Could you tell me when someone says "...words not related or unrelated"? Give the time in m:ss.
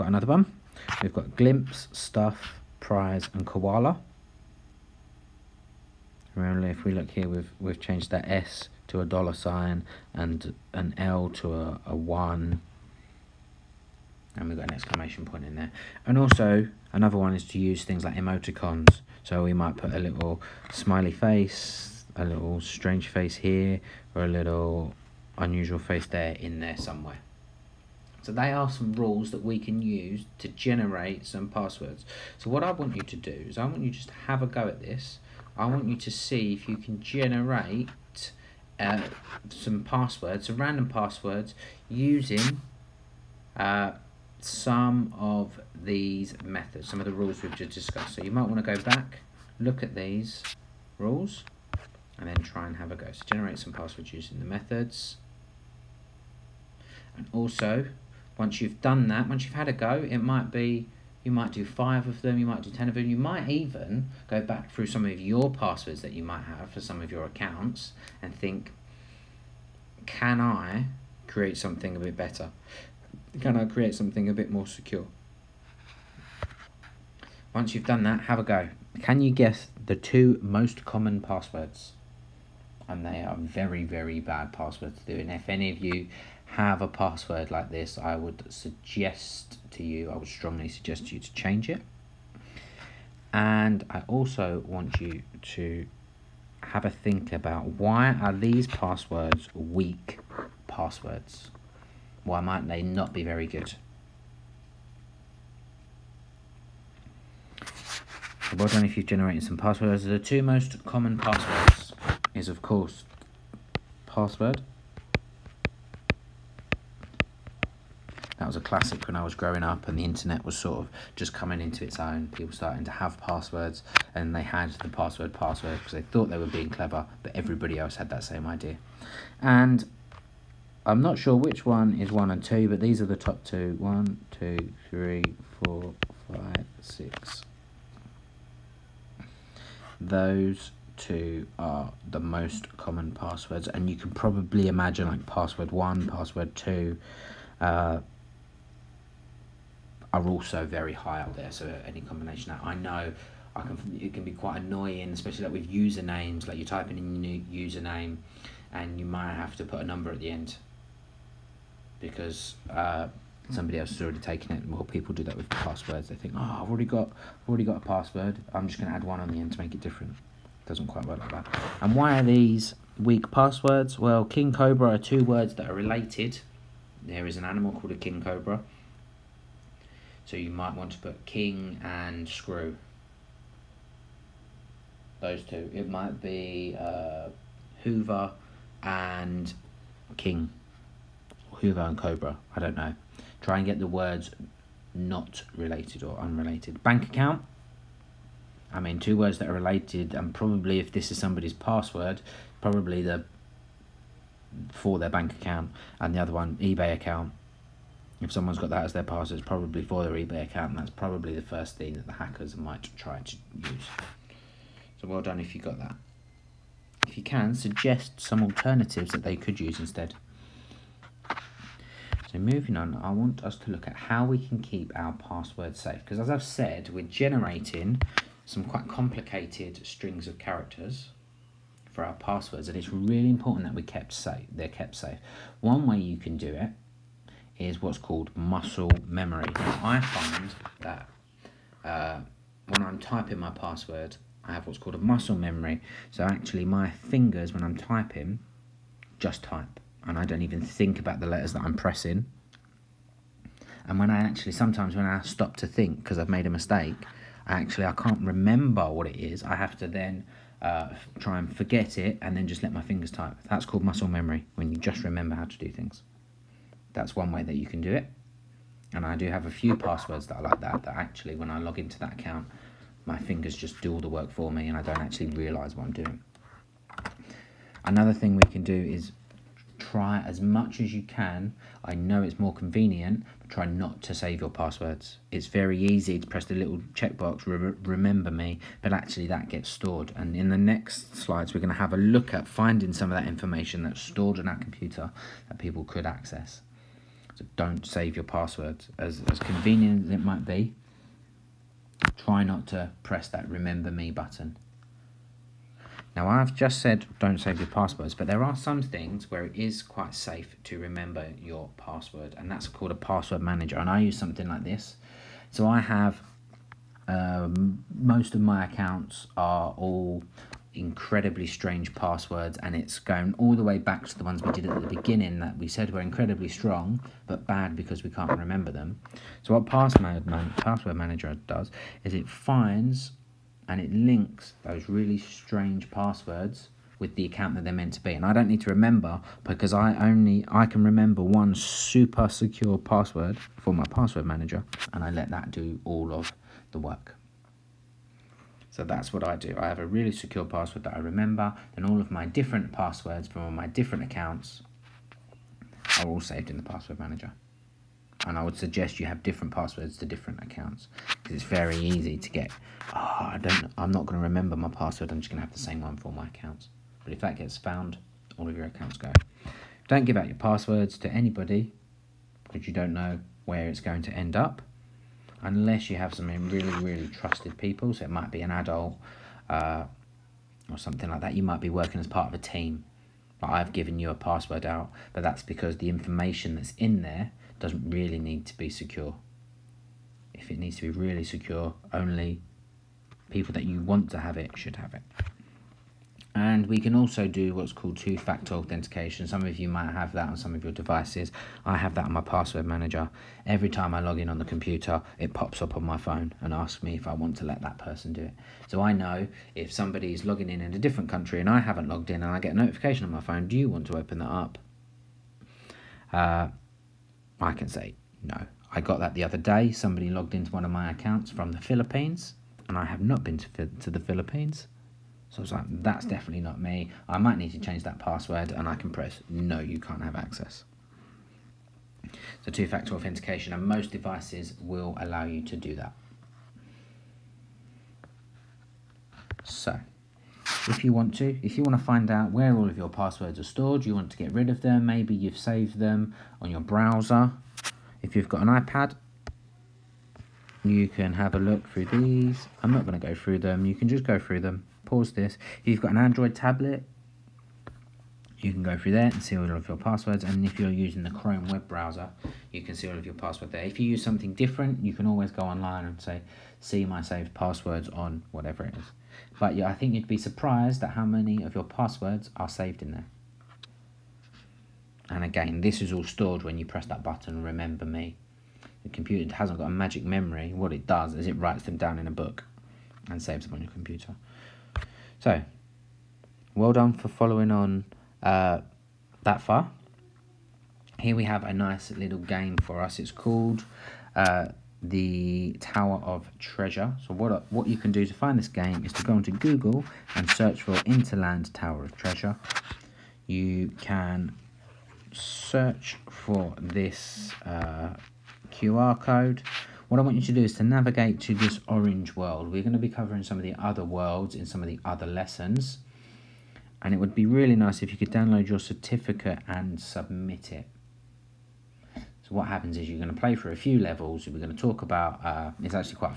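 3:13.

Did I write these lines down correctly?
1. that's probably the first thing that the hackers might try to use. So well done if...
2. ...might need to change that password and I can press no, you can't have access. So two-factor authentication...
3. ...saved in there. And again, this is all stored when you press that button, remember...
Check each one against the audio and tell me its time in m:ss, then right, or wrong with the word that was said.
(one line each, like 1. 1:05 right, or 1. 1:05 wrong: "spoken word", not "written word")
1. 3:30 right
2. 7:07 right
3. 7:52 right.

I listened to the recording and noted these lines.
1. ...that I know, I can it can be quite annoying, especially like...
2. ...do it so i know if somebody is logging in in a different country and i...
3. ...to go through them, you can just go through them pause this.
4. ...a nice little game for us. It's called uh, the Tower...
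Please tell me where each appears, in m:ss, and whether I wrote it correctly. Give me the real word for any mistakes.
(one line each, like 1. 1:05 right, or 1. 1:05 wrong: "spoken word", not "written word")
1. 2:32 right
2. 6:48 right
3. 7:32 right
4. 8:11 right.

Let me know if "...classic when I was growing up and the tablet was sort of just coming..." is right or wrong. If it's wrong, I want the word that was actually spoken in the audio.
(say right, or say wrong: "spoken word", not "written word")
wrong: "internet", not "tablet".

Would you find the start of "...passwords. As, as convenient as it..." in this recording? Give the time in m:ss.
4:58.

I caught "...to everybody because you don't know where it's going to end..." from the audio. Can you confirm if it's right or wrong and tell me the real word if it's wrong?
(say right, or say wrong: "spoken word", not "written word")
wrong: "anybody", not "everybody".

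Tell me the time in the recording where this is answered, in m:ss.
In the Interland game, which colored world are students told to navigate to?
8:31.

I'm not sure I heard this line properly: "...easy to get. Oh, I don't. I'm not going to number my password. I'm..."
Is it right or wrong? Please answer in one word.
wrong.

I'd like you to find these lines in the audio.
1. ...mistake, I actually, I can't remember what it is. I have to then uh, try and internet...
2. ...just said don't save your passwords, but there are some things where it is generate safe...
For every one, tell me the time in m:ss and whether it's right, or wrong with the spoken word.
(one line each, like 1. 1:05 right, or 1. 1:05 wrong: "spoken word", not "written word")
1. 4:16 wrong: "forget", not "internet"
2. 5:06 wrong: "quite", not "generate".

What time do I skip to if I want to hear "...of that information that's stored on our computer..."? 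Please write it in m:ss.
4:53.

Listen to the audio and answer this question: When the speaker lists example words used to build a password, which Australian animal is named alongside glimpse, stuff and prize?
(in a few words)
koala.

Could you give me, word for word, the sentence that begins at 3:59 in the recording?
I find that uh, when I'm typing my password, I have what's called a muscle memory.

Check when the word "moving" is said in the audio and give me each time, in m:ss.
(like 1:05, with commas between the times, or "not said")
3:42.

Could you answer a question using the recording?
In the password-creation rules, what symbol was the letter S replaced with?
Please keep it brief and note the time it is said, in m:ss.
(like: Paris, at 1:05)
dollar sign, at 0:09.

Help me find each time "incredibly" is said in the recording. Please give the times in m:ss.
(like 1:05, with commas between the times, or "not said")
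5:20, 5:25.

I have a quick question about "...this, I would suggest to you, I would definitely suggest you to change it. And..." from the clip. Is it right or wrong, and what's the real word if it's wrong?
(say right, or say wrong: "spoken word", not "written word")
wrong: "strongly", not "definitely".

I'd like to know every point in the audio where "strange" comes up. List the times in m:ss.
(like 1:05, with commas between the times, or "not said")
0:22, 5:21, 5:35.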